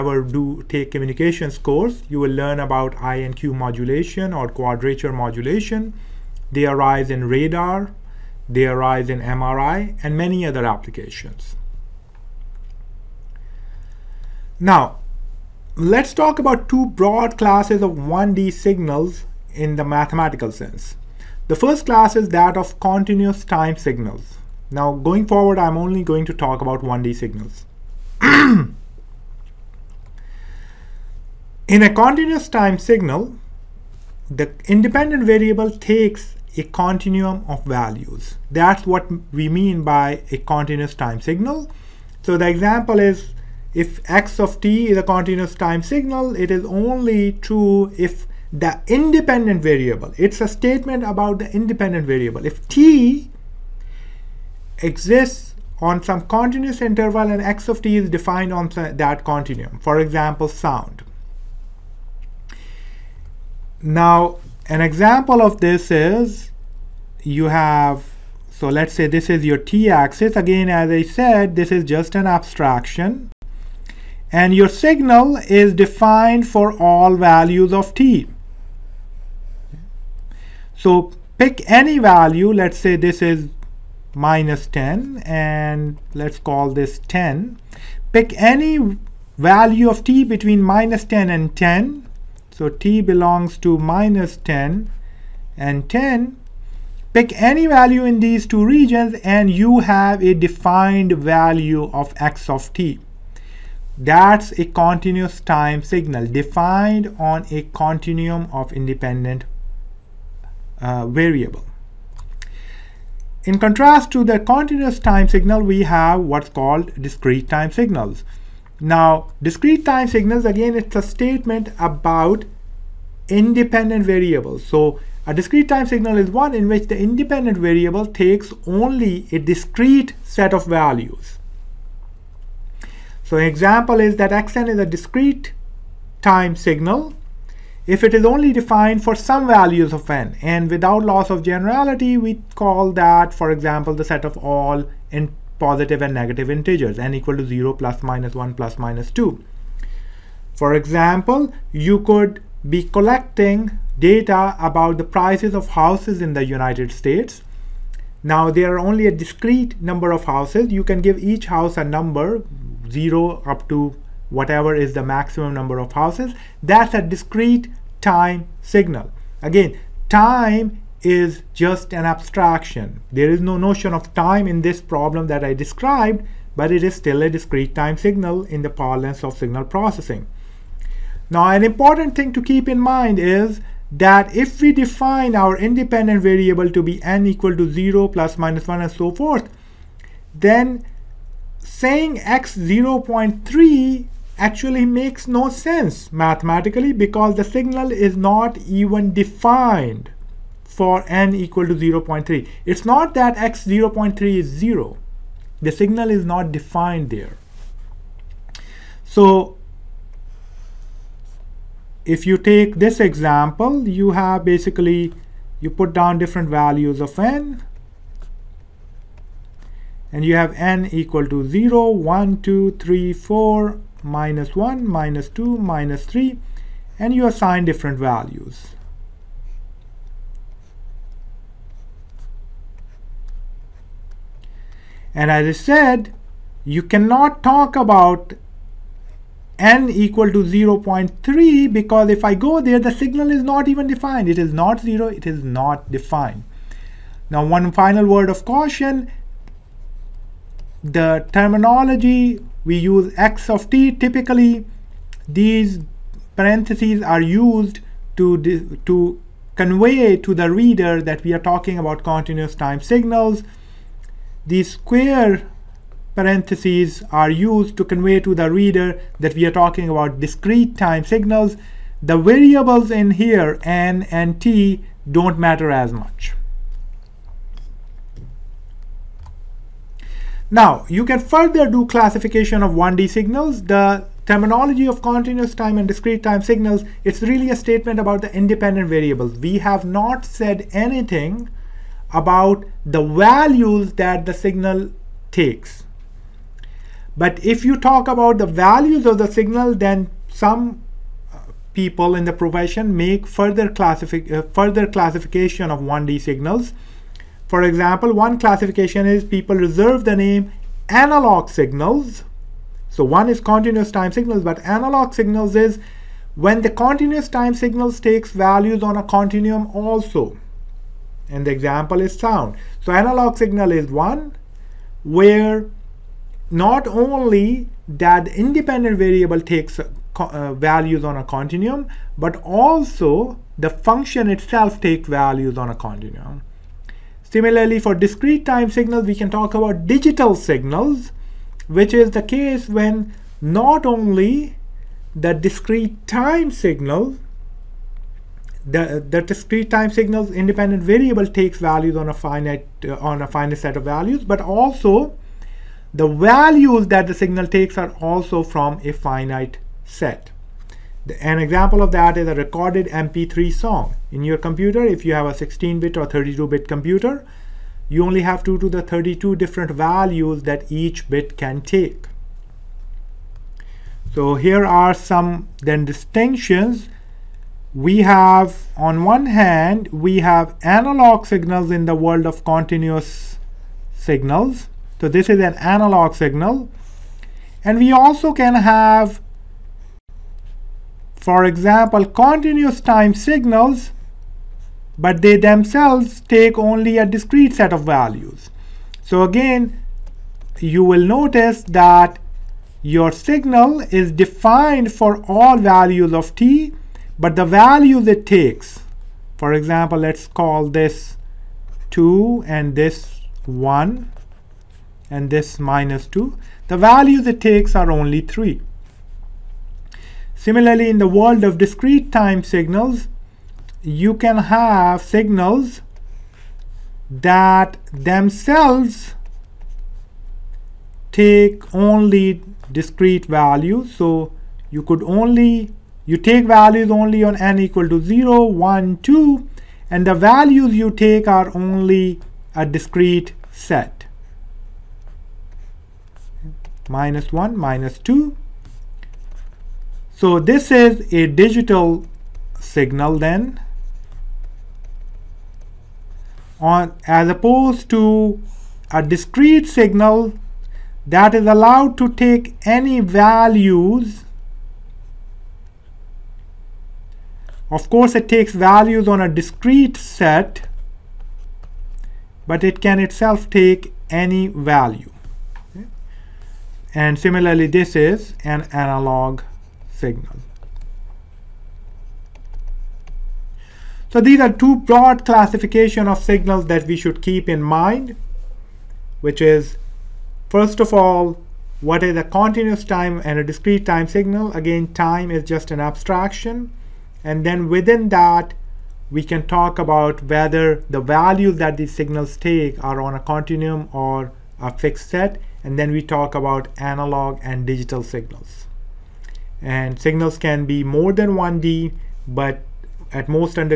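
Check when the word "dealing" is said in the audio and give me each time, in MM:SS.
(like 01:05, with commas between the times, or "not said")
not said.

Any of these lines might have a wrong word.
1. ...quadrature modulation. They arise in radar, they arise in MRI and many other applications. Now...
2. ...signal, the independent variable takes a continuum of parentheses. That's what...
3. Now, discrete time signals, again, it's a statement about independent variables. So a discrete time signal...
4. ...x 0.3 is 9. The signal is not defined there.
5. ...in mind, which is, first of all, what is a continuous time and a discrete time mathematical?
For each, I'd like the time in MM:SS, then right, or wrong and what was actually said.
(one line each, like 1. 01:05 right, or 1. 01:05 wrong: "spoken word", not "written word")
1. 00:04 right
2. 00:32 wrong: "values", not "parentheses"
3. 01:58 right
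4. 03:23 wrong: "0", not "9"
5. 08:07 wrong: "signal", not "mathematical".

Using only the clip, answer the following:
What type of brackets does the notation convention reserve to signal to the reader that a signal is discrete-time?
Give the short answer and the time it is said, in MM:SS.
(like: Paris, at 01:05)
square parentheses, at 04:24.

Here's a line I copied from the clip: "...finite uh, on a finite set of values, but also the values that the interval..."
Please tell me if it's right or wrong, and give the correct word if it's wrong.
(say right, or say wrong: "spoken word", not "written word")
wrong: "signal", not "interval".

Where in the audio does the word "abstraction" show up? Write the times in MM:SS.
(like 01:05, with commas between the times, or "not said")
01:12, 02:52, 08:15.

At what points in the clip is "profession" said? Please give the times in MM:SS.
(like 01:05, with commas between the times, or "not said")
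05:02.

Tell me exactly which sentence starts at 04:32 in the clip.
The variables in here, n and t, don't matter as much.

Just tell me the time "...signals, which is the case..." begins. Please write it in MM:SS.
05:40.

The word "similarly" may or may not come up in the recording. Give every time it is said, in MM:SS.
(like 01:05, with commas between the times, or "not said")
05:37, 07:00, 07:57.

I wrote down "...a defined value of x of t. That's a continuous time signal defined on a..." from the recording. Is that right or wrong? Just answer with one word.
right.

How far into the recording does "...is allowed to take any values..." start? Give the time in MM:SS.
07:41.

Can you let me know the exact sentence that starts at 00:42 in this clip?
So the example is if x of t is a continuous time signal, it is only true if the independent variable.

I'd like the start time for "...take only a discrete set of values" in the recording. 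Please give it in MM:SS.
06:36.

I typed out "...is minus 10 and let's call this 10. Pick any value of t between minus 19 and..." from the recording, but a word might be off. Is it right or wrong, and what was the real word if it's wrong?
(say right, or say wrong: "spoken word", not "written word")
wrong: "10", not "19".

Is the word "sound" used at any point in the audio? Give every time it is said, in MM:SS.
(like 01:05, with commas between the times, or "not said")
01:00, 05:22.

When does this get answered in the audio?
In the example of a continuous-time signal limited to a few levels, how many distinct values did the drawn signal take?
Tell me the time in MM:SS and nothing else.
06:57.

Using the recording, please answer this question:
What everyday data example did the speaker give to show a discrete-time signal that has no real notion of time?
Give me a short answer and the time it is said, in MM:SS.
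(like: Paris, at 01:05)
prices of houses, at 02:34.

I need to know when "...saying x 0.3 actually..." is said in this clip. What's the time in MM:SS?
03:11.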